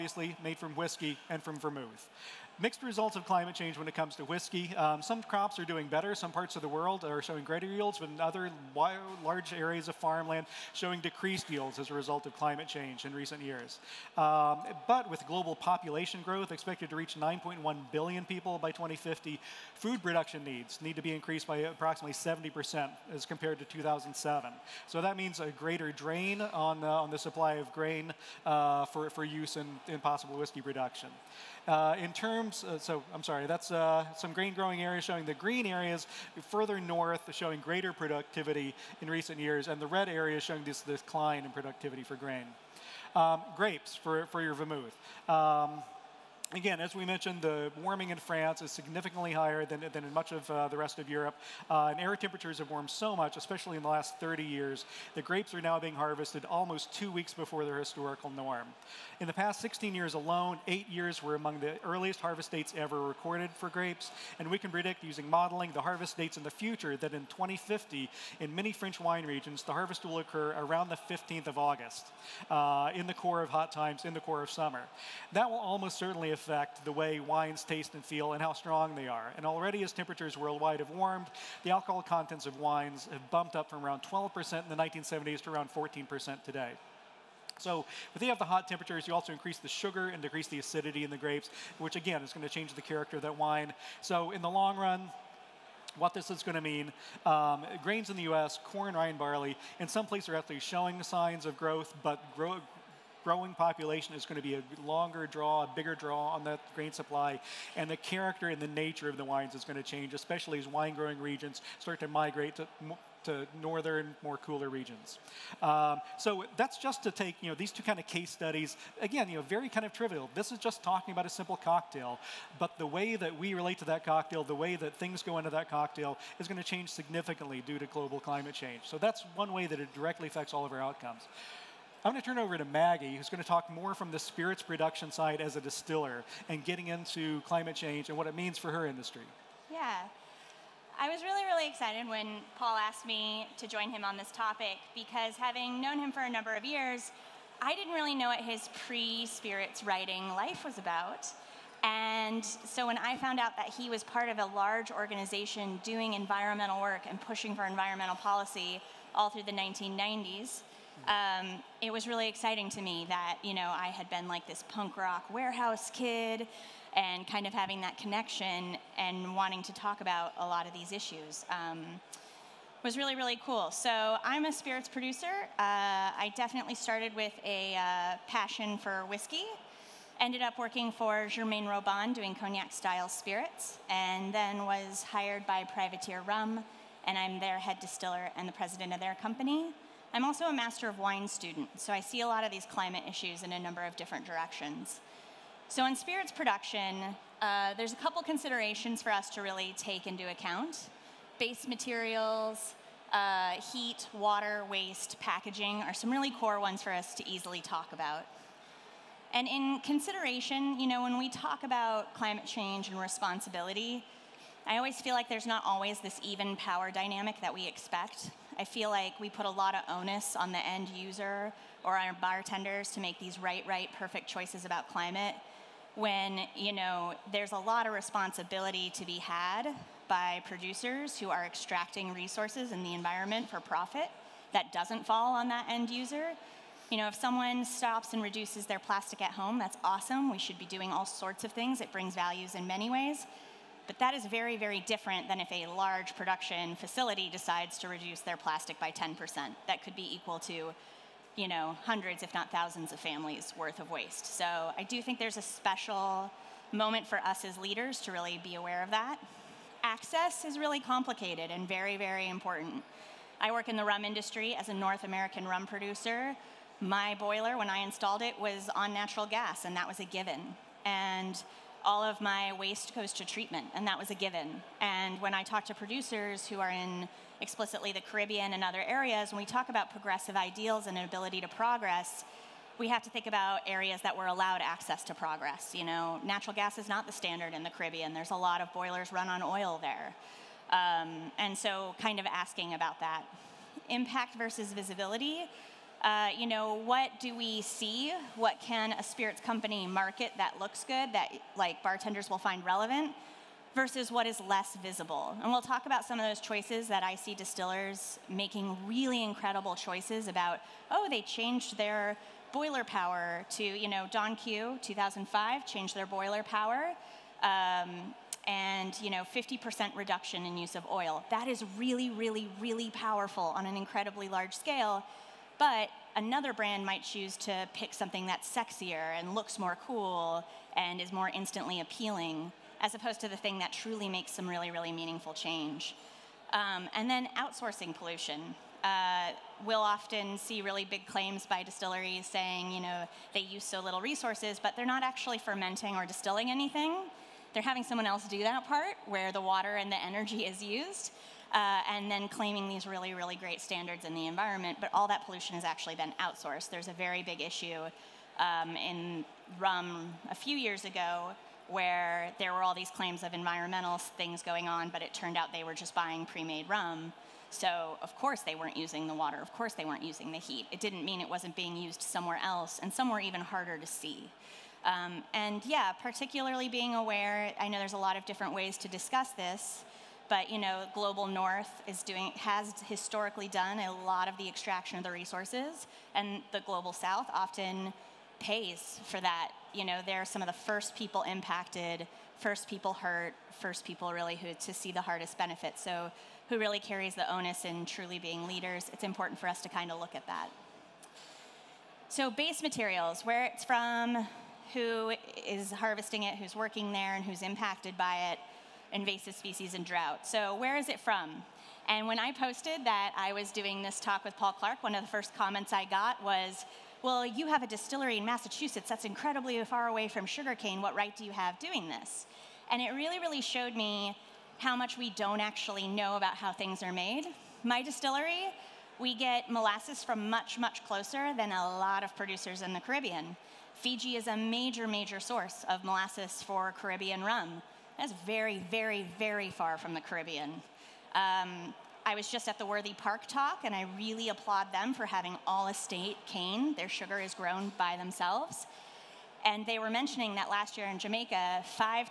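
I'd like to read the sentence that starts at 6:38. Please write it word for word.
It's important for us to kind of look at that.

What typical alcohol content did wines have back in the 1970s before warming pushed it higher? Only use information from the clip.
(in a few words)
12%.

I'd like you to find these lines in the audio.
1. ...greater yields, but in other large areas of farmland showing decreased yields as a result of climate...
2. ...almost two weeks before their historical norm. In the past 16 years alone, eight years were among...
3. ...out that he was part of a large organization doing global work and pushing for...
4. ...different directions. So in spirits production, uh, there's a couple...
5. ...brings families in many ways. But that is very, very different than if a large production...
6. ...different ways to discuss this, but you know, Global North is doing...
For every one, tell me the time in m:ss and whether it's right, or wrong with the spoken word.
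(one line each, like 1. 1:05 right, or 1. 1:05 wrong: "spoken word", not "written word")
1. 0:07 right
2. 0:56 right
3. 2:33 wrong: "environmental", not "global"
4. 3:13 right
5. 4:01 wrong: "values", not "families"
6. 6:18 right.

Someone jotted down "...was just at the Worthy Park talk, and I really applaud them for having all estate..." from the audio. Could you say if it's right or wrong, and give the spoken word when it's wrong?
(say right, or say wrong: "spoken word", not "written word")
right.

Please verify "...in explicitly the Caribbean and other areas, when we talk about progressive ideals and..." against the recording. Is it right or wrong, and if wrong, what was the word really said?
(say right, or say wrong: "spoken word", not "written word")
right.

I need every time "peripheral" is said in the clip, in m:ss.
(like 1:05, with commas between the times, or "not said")
not said.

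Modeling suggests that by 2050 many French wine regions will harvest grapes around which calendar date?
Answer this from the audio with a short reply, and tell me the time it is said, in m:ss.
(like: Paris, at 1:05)
15th of August, at 1:11.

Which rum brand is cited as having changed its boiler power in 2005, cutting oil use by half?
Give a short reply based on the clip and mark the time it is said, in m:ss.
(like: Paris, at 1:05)
Don Q, at 5:14.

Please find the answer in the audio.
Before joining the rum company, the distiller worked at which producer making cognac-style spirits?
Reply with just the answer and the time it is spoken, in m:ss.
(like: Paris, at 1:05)
Germain-Robin, at 3:01.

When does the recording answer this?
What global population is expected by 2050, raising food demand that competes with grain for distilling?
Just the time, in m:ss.
0:17.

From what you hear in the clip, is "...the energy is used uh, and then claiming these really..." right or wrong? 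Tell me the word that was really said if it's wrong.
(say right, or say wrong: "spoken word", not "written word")
right.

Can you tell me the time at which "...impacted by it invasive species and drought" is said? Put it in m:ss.
6:47.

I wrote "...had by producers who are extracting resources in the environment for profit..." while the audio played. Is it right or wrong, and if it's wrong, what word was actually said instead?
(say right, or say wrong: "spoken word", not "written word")
right.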